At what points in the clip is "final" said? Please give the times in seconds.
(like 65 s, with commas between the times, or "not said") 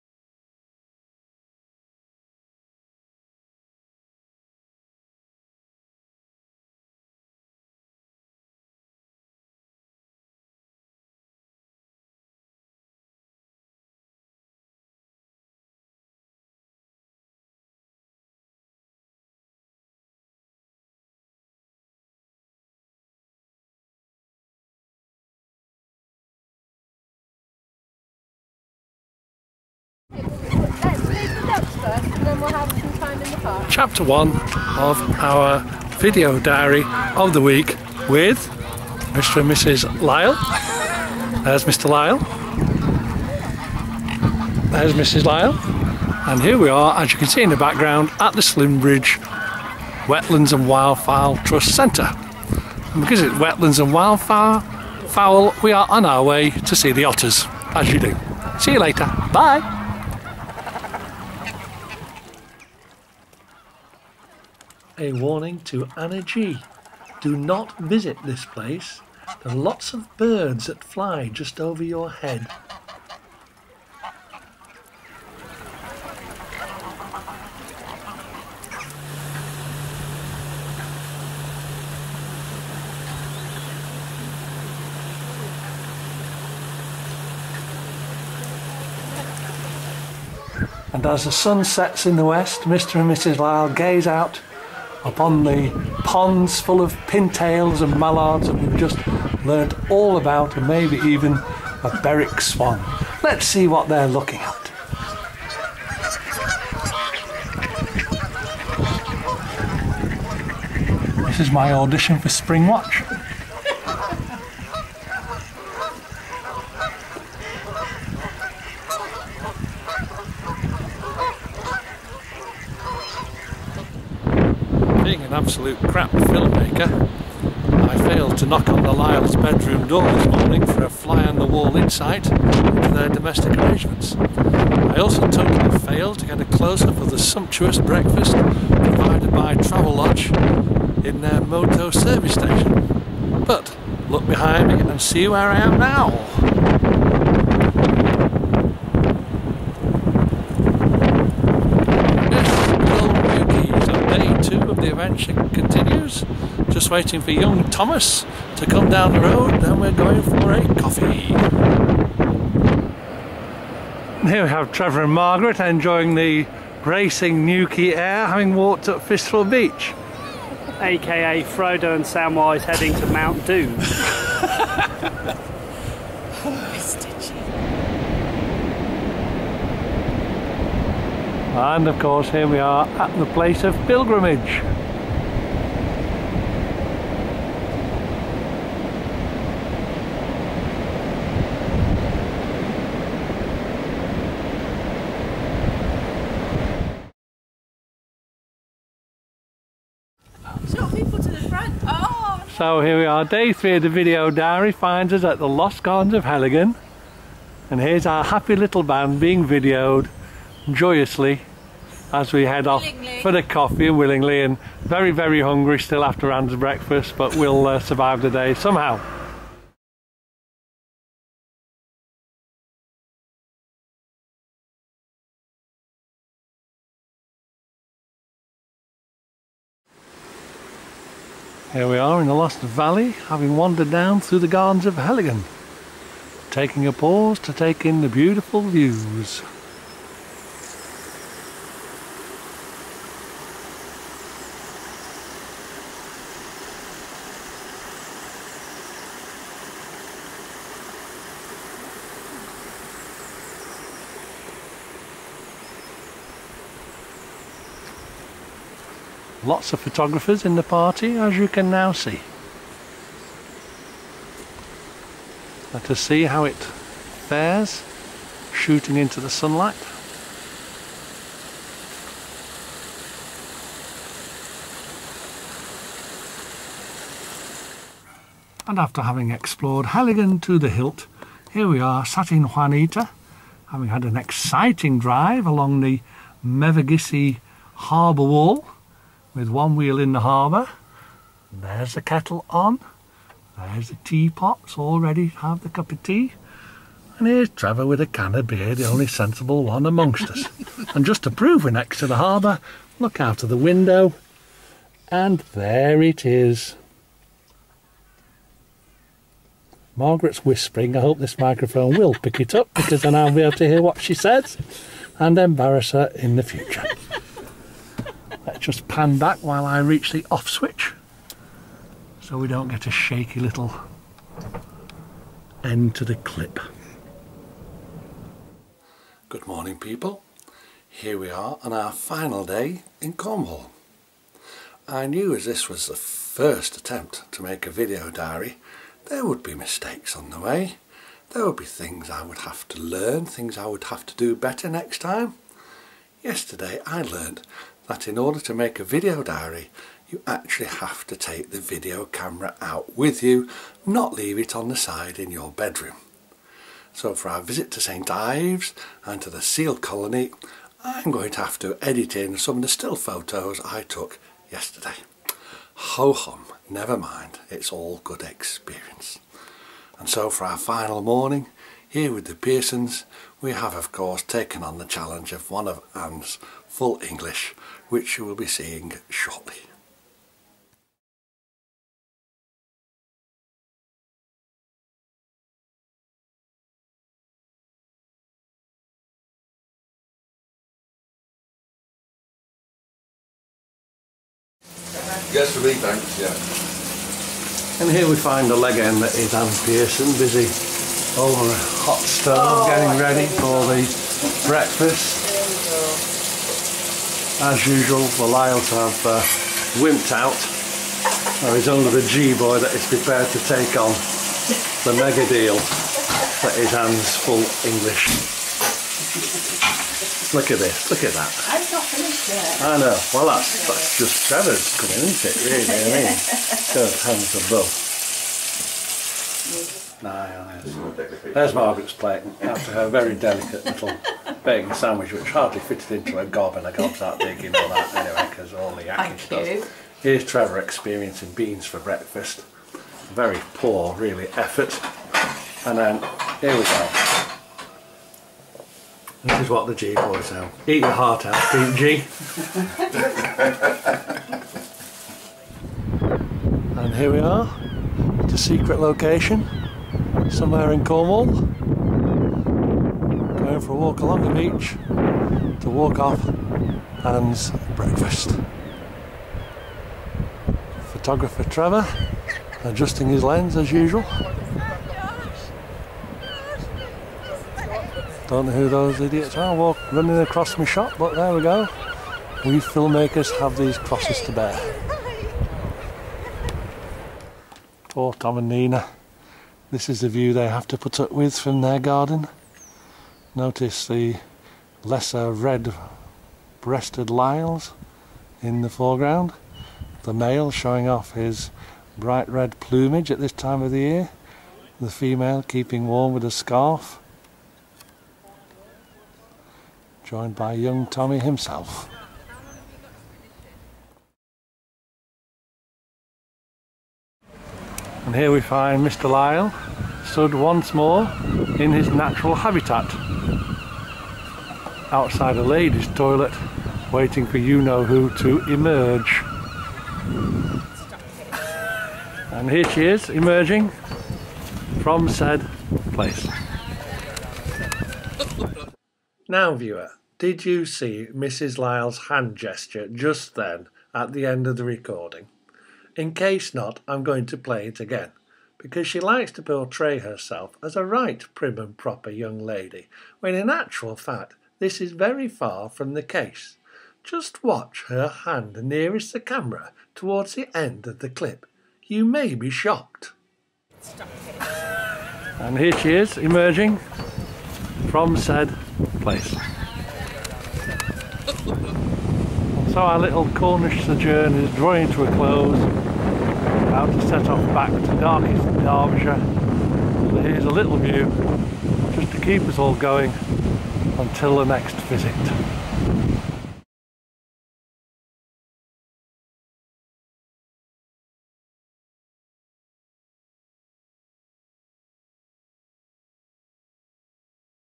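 331 s, 370 s.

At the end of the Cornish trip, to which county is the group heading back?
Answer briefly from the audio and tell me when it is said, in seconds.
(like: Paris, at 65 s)
Derbyshire, at 578 s.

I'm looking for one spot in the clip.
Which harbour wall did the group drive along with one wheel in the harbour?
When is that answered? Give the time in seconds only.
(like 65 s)
286 s.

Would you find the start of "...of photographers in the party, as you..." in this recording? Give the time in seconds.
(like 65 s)
259 s.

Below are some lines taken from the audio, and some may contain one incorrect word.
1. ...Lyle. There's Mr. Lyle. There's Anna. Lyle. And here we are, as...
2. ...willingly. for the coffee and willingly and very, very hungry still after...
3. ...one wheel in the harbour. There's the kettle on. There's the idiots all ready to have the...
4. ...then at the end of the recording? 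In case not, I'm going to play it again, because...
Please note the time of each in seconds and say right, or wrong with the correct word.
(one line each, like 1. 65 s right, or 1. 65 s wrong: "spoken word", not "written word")
1. 40 s wrong: "Mrs", not "Anna"
2. 212 s right
3. 289 s wrong: "teapots", not "idiots"
4. 543 s right.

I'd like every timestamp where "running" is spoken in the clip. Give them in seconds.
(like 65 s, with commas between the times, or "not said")
479 s.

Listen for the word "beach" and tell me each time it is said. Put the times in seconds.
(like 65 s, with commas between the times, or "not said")
169 s, 464 s.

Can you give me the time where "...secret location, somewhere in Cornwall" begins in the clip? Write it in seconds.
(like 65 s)
458 s.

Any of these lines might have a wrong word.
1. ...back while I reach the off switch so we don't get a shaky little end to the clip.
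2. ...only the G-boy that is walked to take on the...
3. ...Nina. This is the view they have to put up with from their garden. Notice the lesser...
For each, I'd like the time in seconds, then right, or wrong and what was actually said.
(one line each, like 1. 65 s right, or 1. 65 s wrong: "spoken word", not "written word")
1. 319 s right
2. 411 s wrong: "prepared", not "walked"
3. 488 s right.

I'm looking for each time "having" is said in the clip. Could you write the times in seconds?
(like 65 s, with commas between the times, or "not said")
168 s, 233 s, 279 s, 283 s.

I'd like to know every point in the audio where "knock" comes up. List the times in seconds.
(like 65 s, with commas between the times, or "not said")
128 s.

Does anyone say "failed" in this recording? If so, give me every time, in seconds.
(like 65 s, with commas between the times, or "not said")
128 s, 135 s.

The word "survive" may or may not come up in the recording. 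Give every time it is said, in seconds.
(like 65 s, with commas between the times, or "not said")
217 s.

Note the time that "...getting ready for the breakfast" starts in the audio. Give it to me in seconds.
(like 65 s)
402 s.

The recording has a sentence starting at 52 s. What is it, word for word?
And because it's wetlands and wildfowl, we are on our way to see the otters, as you do.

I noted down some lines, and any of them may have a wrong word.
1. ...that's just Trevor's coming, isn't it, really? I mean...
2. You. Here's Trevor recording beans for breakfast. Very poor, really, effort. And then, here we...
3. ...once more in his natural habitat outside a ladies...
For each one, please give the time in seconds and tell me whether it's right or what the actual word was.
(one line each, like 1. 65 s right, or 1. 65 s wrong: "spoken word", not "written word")
1. 423 s right
2. 439 s wrong: "experiencing", not "recording"
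3. 520 s right.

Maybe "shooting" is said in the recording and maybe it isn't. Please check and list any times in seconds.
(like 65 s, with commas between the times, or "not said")
268 s.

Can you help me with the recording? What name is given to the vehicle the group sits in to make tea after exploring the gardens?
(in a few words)
Juanita.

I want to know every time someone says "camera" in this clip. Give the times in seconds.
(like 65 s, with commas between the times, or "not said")
352 s, 559 s.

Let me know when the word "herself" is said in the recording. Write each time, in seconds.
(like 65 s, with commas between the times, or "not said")
549 s.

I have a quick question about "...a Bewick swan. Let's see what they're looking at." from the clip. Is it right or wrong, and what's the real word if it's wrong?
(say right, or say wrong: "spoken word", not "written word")
right.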